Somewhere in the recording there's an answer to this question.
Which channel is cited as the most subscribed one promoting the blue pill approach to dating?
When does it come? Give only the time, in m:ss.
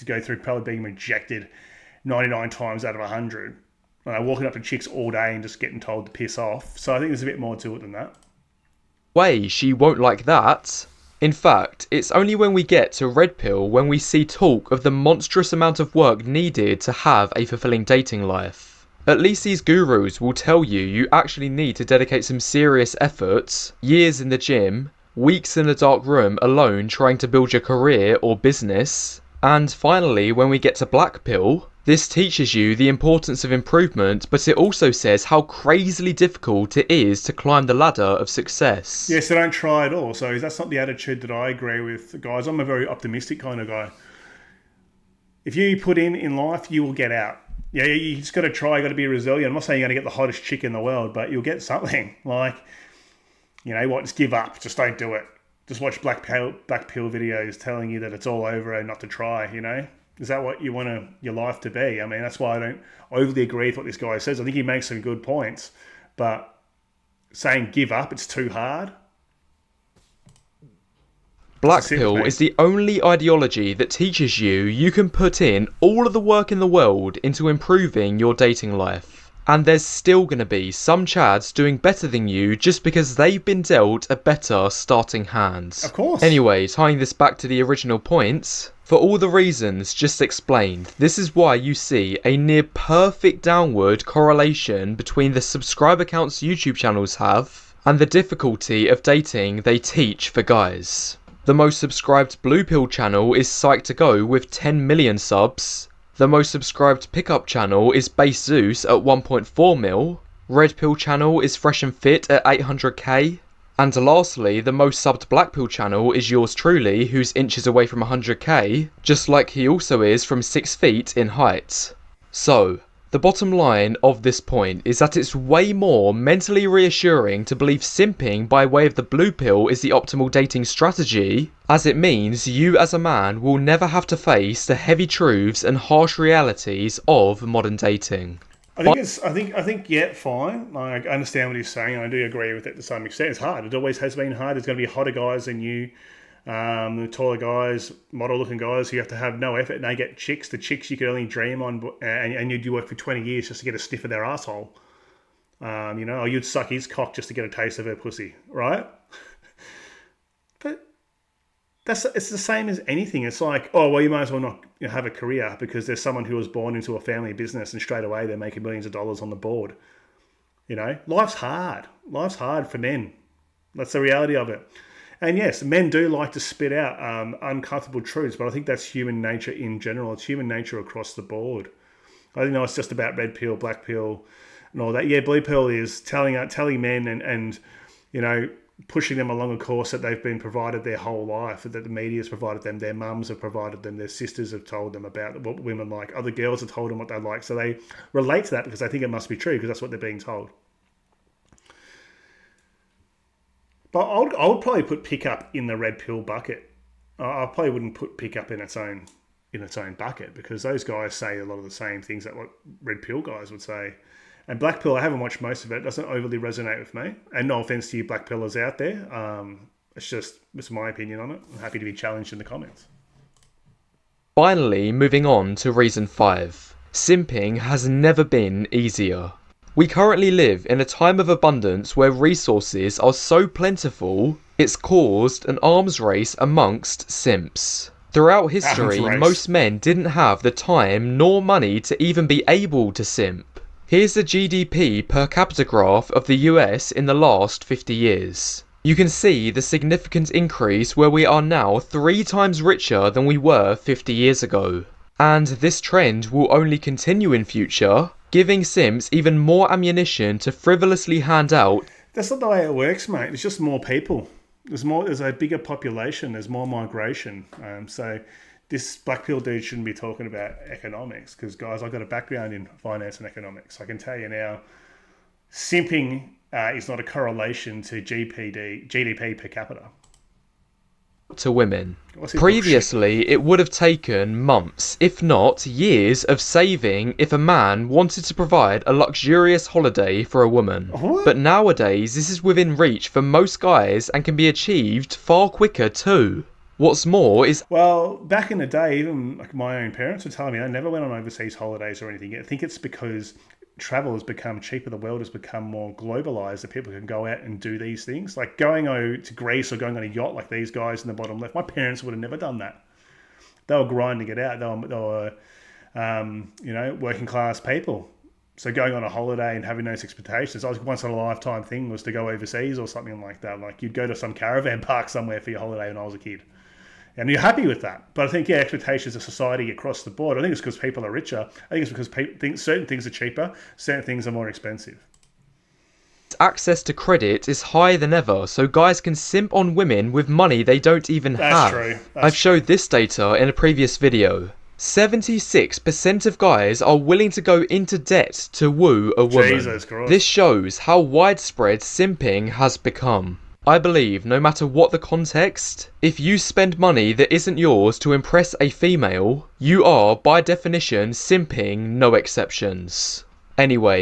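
1:43.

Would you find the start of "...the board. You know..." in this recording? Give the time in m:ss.
2:49.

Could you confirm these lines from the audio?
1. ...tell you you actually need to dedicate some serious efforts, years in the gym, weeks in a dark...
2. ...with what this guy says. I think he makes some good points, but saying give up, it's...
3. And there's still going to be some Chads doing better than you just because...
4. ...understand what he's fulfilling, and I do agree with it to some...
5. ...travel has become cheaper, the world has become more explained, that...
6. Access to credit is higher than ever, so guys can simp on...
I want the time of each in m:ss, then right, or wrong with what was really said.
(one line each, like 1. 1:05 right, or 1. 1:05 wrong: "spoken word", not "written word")
1. 0:20 right
2. 1:03 right
3. 1:19 right
4. 2:21 wrong: "saying", not "fulfilling"
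5. 5:03 wrong: "globalized", not "explained"
6. 5:36 right.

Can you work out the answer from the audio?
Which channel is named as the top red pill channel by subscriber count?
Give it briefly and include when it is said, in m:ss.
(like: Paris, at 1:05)
Fresh and Fit, at 1:51.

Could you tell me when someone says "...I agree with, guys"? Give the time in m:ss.
0:41.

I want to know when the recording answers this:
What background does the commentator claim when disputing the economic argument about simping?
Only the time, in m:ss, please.
4:32.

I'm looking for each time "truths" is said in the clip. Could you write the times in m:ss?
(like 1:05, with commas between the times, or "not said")
2:15, 2:58.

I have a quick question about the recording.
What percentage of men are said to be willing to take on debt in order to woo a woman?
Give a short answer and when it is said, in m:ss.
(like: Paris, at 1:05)
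76%, at 5:44.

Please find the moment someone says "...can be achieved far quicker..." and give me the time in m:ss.
4:54.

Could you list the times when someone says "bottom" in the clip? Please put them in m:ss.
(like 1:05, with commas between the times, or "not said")
2:03, 5:11.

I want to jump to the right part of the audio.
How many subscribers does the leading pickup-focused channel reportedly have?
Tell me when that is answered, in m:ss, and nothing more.
1:49.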